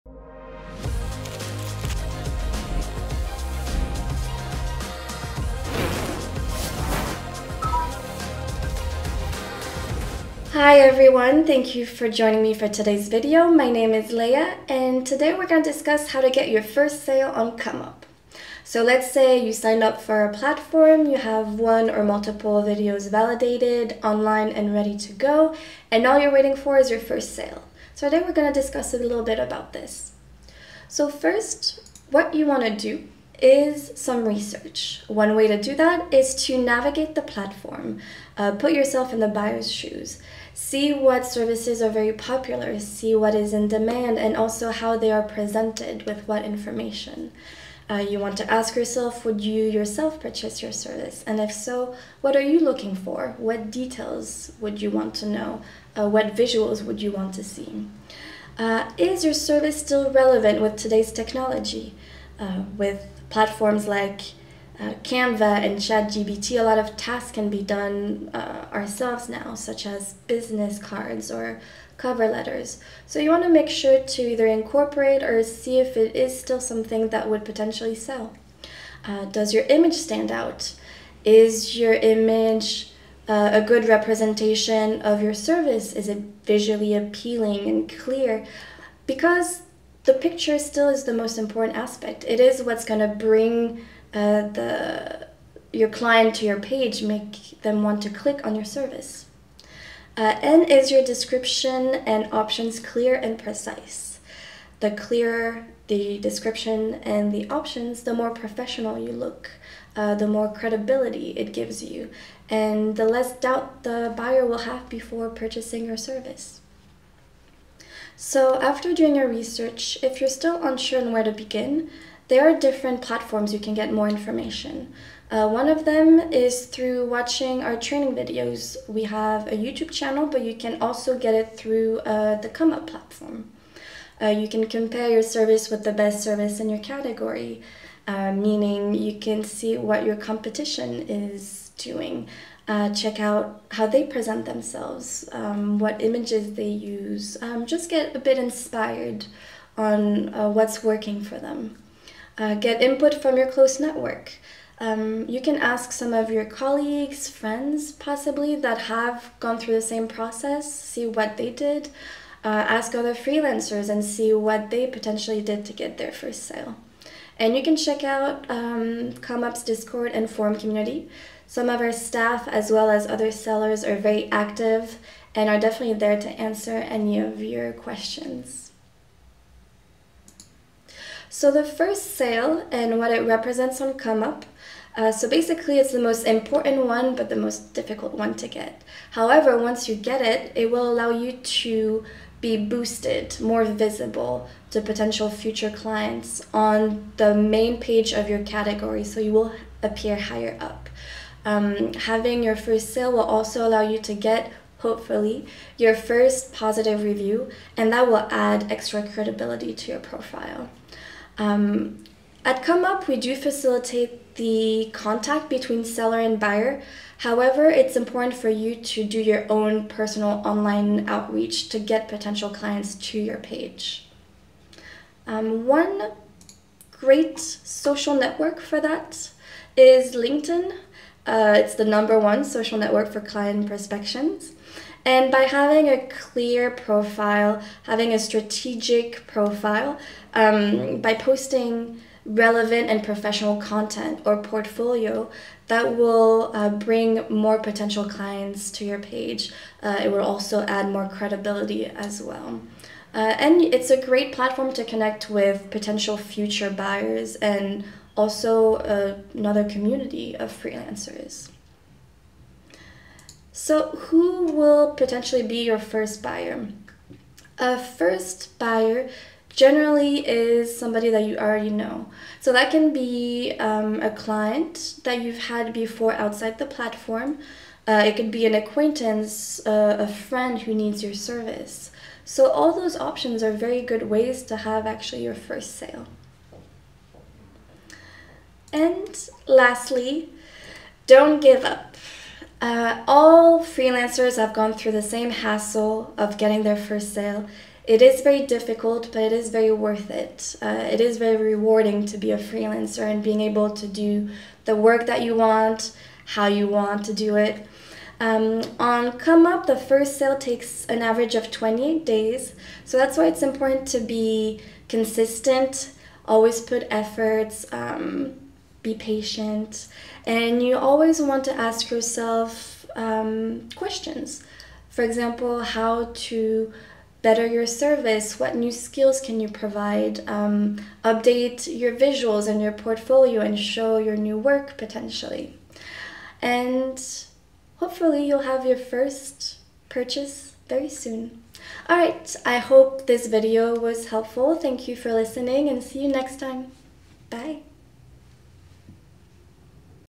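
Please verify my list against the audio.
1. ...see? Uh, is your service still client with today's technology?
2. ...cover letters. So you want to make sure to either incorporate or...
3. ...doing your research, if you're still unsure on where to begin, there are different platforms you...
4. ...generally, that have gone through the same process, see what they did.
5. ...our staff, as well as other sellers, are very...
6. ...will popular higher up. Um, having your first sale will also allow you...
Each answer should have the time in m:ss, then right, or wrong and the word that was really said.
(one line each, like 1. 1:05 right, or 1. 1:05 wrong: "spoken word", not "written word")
1. 0:57 wrong: "relevant", not "client"
2. 1:11 right
3. 1:58 right
4. 2:37 wrong: "possibly", not "generally"
5. 2:51 right
6. 3:19 wrong: "appear", not "popular".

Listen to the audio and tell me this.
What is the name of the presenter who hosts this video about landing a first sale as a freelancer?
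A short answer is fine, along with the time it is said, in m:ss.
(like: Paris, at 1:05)
Leah, at 0:14.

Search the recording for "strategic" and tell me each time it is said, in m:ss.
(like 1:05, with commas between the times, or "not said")
3:58.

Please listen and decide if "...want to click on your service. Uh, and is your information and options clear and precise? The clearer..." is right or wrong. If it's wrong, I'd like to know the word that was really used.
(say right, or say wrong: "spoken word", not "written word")
wrong: "description", not "information".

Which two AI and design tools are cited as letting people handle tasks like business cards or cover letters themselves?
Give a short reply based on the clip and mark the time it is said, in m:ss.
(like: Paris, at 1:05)
Canva and ChatGPT, at 1:05.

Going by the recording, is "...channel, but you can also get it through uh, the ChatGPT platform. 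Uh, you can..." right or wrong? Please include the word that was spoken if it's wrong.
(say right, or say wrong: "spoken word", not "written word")
wrong: "ComeUp", not "ChatGPT".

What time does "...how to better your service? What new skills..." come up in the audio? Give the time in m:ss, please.
5:25.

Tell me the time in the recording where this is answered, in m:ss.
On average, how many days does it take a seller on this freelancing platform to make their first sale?
5:11.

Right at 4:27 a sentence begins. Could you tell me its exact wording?
A first buyer generally is somebody that you already know.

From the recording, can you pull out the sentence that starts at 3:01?
So the first sale and what it represents on ComeUp.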